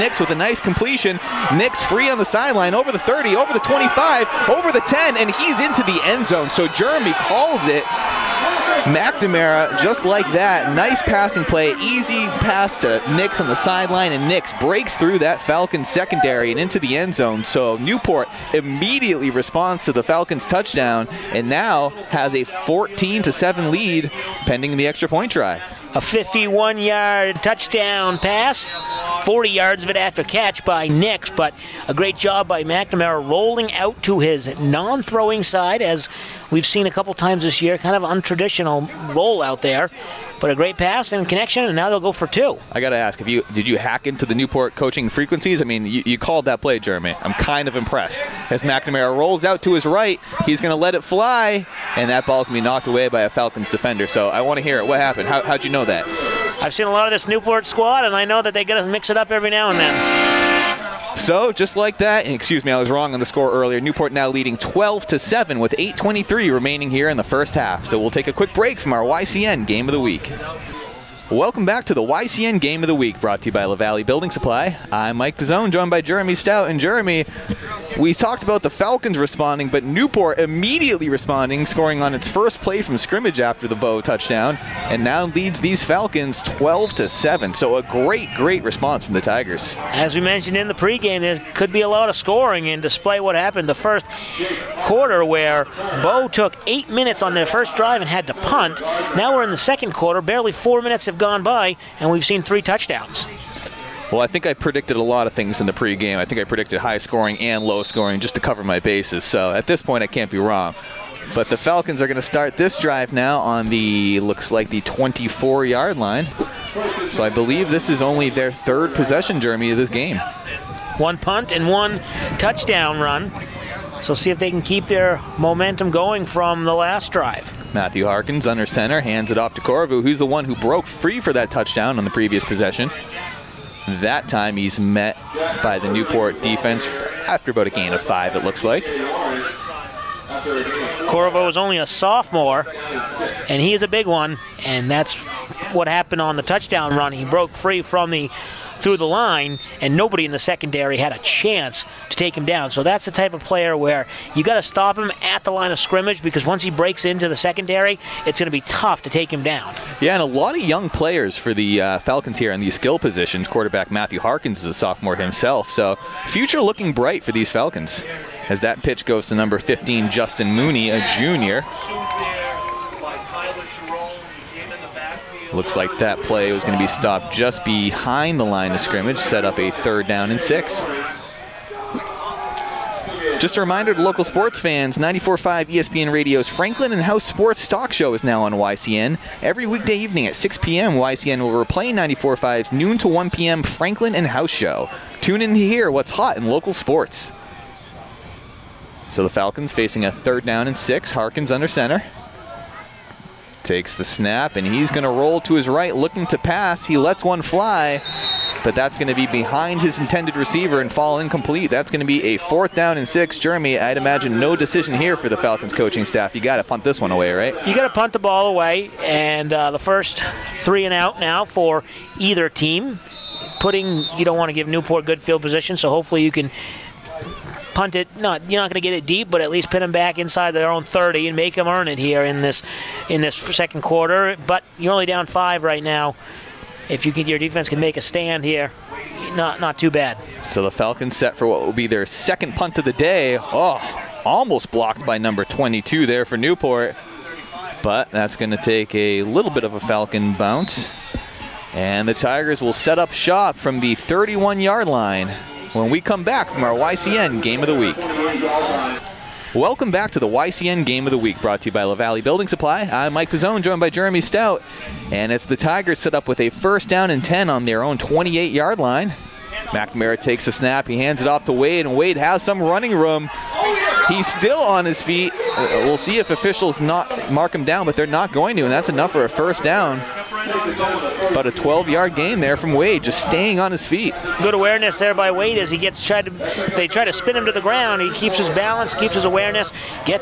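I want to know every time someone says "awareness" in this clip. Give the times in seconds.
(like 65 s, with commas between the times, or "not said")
284 s, 289 s.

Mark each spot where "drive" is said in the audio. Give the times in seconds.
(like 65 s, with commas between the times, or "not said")
97 s, 112 s, 127 s.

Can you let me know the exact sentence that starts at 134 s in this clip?
That time he's met by the Newport defense after about a gain of five, it looks like.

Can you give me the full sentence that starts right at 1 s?
Nix free on the sideline, over the 30, over the 25, over the 10, and he's into the end zone.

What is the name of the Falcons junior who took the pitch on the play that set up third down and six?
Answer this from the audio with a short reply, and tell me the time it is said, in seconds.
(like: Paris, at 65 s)
Justin Mooney, at 170 s.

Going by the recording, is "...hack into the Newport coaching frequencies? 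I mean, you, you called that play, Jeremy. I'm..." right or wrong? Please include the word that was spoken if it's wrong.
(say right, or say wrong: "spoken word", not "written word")
right.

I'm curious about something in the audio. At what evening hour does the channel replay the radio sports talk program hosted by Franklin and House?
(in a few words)
6 p.m.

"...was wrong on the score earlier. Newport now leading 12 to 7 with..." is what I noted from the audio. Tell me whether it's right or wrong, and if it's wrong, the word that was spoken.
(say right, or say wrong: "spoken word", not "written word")
right.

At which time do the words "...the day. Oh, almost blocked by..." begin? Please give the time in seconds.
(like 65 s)
242 s.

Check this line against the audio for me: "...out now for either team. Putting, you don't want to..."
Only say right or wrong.
right.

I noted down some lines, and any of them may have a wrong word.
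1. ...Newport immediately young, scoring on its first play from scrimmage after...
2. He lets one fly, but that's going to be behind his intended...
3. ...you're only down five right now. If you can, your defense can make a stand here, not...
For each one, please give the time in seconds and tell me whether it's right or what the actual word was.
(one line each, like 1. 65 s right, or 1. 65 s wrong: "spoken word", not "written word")
1. 79 s wrong: "responding", not "young"
2. 206 s right
3. 234 s right.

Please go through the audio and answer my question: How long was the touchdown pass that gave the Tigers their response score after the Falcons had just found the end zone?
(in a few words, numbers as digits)
51 yards.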